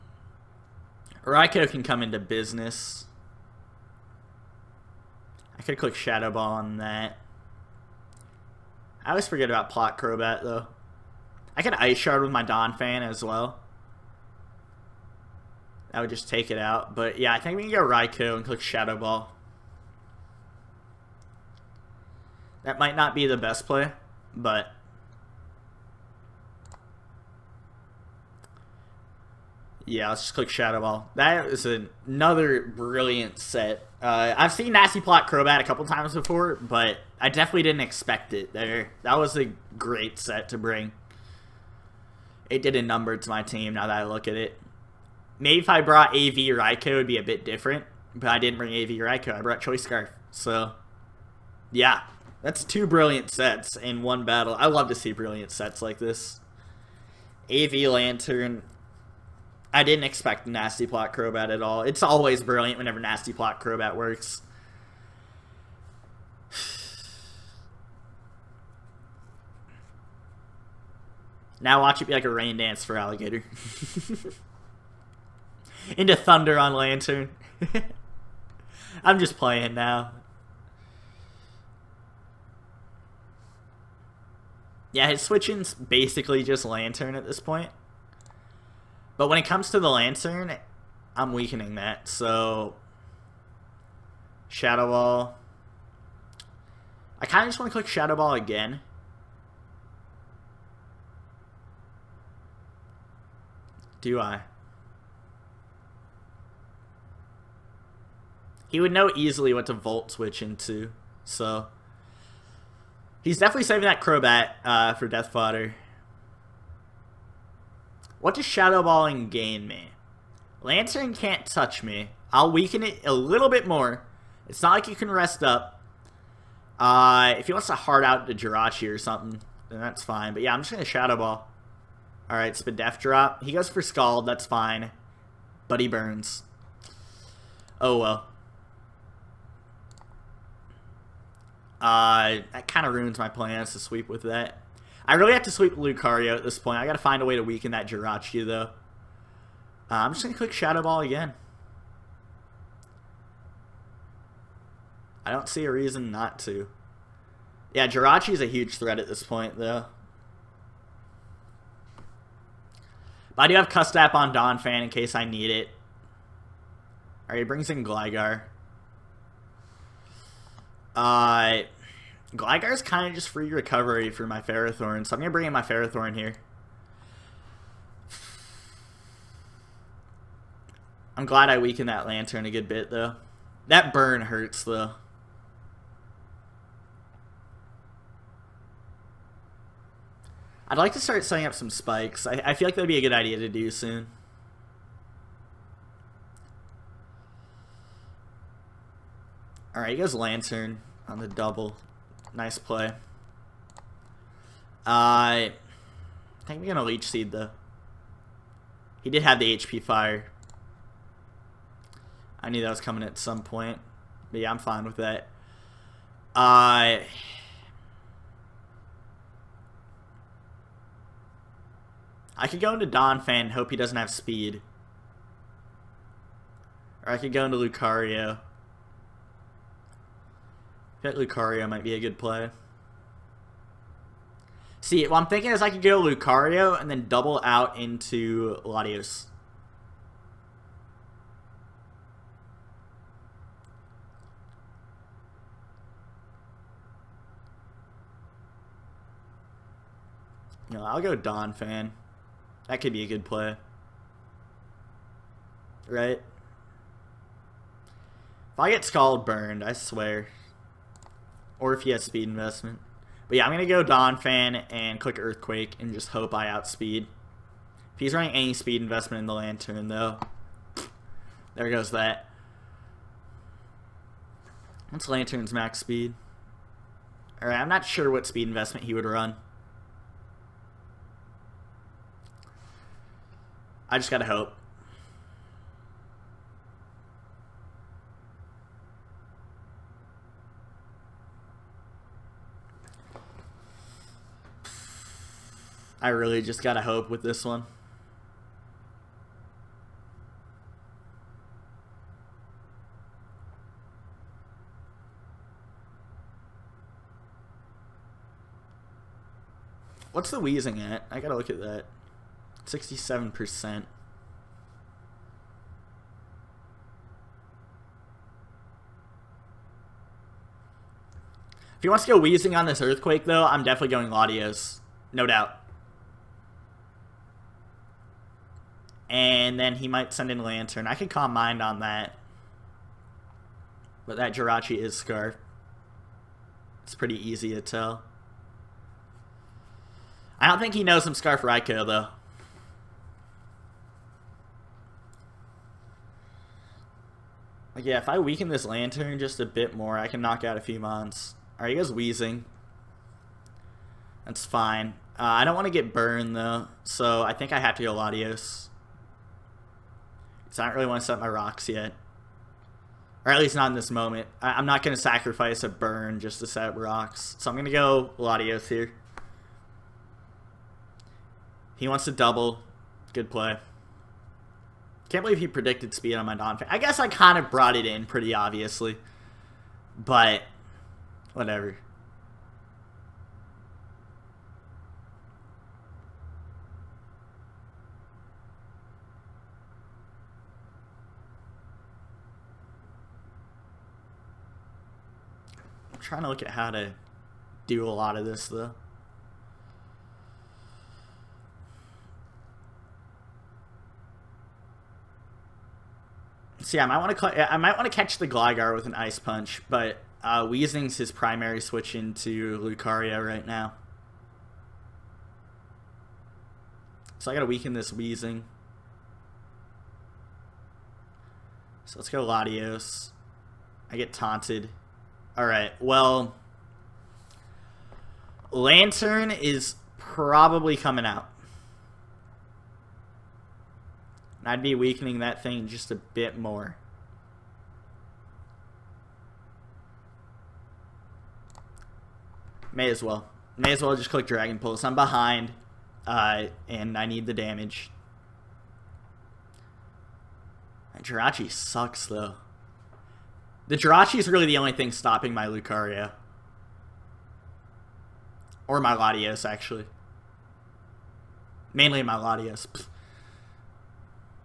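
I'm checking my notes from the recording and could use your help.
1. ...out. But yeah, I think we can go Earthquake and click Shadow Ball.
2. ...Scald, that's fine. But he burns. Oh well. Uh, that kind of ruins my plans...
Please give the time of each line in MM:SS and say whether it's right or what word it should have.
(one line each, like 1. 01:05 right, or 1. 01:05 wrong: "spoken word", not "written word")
1. 00:16 wrong: "Raikou", not "Earthquake"
2. 02:13 right.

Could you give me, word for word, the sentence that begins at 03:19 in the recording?
All right, he goes Lanturn on the double.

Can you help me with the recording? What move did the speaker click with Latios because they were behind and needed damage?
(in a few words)
Dragon Pulse.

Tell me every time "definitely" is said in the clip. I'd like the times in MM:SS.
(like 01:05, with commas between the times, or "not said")
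00:37, 01:53, 05:23.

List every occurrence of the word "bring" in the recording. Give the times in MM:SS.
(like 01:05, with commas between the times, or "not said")
00:40, 00:48, 02:47, 02:55.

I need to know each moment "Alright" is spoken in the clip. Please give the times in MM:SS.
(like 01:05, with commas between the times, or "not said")
02:12, 02:47, 04:37, 07:05.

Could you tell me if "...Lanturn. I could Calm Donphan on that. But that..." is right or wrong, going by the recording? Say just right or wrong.
wrong.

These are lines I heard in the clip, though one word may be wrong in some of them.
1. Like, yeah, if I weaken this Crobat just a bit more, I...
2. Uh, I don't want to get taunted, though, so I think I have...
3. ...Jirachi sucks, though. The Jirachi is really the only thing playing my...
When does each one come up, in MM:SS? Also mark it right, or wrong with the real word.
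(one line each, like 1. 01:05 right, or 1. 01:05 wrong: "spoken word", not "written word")
1. 05:47 wrong: "Lanturn", not "Crobat"
2. 05:55 wrong: "burned", not "taunted"
3. 07:31 wrong: "stopping", not "playing".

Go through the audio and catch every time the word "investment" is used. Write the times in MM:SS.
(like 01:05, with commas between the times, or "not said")
04:22, 04:28, 04:38.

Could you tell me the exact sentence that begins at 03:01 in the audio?
I'm glad I weakened that Lanturn a good bit, though.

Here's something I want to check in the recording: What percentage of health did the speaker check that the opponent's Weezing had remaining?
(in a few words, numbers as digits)
67%.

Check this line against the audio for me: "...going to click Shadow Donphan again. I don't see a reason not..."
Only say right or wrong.
wrong.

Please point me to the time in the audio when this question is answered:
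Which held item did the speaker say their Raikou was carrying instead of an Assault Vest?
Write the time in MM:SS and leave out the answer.
00:49.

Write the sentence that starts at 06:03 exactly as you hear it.
Or at least not in this moment.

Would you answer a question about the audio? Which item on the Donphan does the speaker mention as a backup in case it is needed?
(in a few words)
Custap.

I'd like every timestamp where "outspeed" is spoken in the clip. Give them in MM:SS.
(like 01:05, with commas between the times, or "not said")
04:26.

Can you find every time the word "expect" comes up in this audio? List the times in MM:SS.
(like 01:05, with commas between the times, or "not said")
00:37, 01:00.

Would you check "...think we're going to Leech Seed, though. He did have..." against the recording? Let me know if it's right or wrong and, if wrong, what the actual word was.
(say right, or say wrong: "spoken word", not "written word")
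right.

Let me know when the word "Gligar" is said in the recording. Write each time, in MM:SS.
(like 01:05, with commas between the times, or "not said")
02:47, 02:52, 06:48.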